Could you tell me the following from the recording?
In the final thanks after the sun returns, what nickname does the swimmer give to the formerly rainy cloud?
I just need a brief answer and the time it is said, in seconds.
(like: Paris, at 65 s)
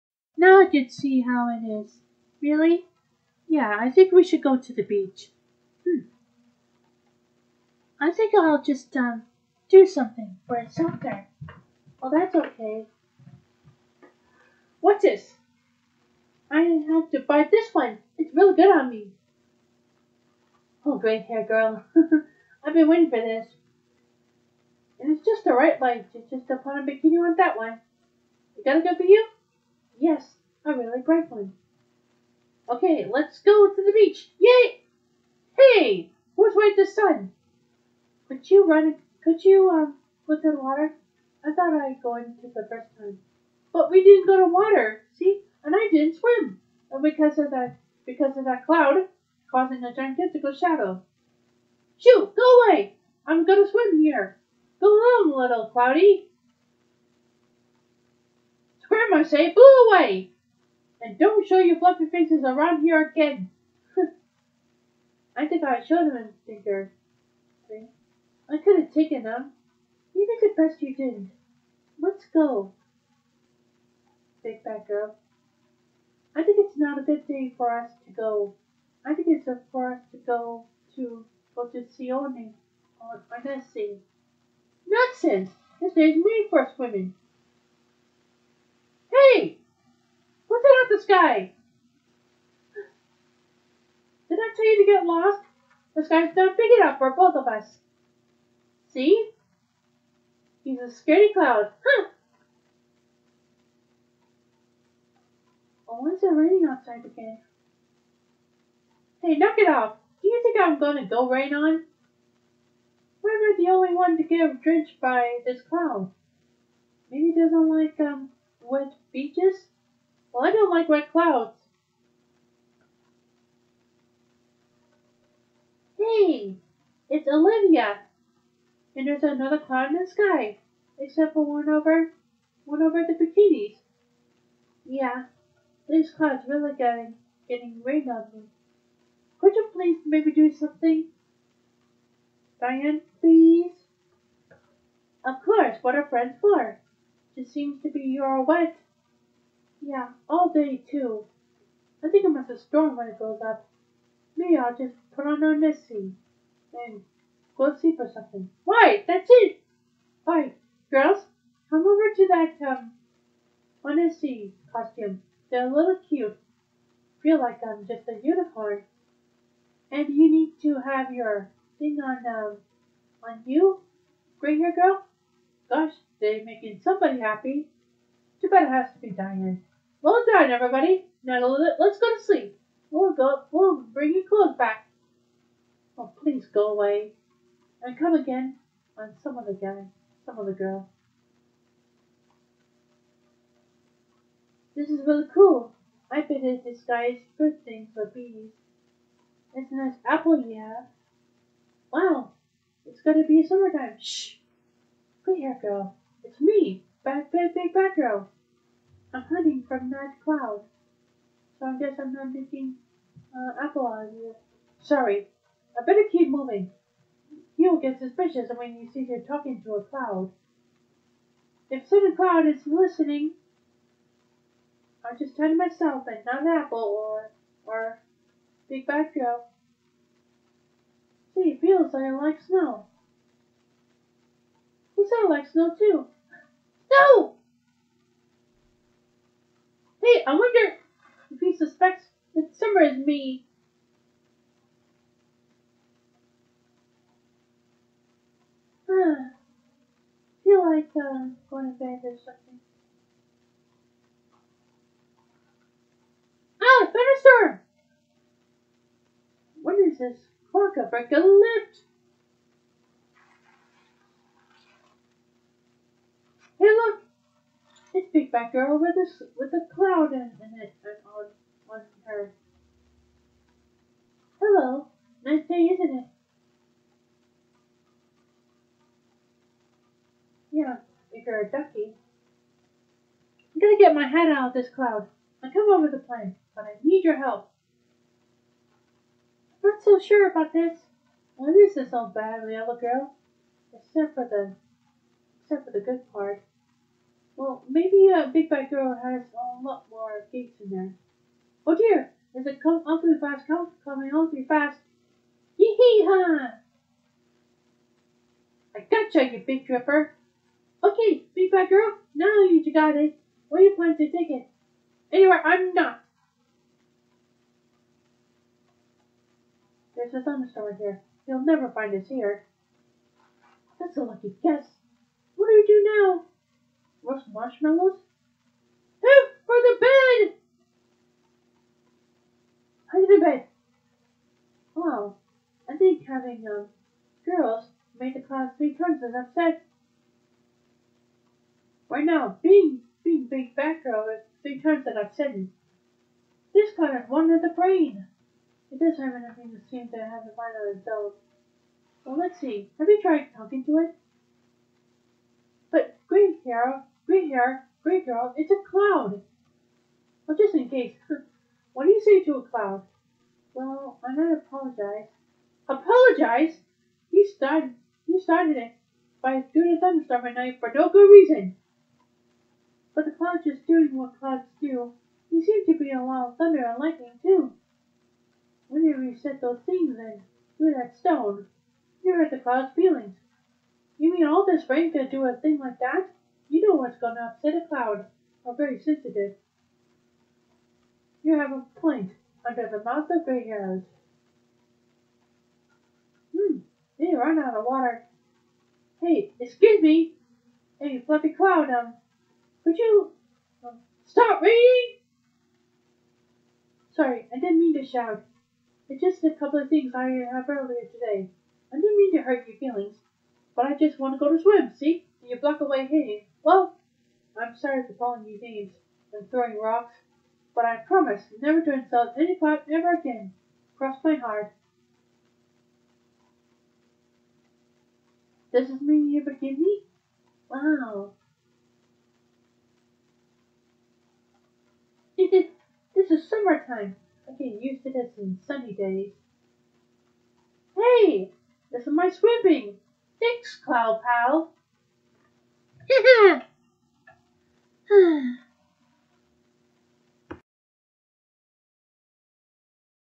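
Cloud Pal, at 443 s.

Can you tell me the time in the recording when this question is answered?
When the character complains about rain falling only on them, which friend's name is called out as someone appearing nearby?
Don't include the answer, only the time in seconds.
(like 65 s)
127 s.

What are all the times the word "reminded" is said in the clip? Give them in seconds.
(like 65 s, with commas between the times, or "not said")
not said.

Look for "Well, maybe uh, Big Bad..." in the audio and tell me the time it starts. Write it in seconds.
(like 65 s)
297 s.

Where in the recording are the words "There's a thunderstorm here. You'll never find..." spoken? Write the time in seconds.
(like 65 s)
319 s.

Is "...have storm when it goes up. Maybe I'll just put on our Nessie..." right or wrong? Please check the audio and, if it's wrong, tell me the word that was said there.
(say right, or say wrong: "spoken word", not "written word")
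right.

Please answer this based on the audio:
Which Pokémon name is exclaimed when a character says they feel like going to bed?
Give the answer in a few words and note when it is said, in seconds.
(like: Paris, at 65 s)
Venusaur, at 256 s.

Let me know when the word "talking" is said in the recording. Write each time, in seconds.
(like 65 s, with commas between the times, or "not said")
219 s, 353 s.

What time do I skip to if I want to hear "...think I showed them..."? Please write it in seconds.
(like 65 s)
65 s.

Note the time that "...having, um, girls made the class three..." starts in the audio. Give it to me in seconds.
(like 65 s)
336 s.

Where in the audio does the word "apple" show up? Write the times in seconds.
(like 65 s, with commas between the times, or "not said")
200 s, 213 s, 226 s.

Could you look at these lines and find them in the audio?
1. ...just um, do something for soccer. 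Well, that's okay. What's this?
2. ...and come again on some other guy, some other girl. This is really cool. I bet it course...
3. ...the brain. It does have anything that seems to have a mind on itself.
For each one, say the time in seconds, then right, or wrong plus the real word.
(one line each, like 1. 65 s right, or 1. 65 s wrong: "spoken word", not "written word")
1. 8 s right
2. 187 s wrong: "disguise", not "course"
3. 347 s right.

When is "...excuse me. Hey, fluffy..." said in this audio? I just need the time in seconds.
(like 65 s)
399 s.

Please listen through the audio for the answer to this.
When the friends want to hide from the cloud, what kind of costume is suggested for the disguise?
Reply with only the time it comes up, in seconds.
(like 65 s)
163 s.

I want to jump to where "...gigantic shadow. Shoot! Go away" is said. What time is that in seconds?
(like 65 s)
49 s.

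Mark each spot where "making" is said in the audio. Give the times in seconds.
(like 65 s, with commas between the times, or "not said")
176 s, 212 s.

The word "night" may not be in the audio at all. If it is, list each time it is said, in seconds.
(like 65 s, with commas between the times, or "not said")
209 s, 370 s.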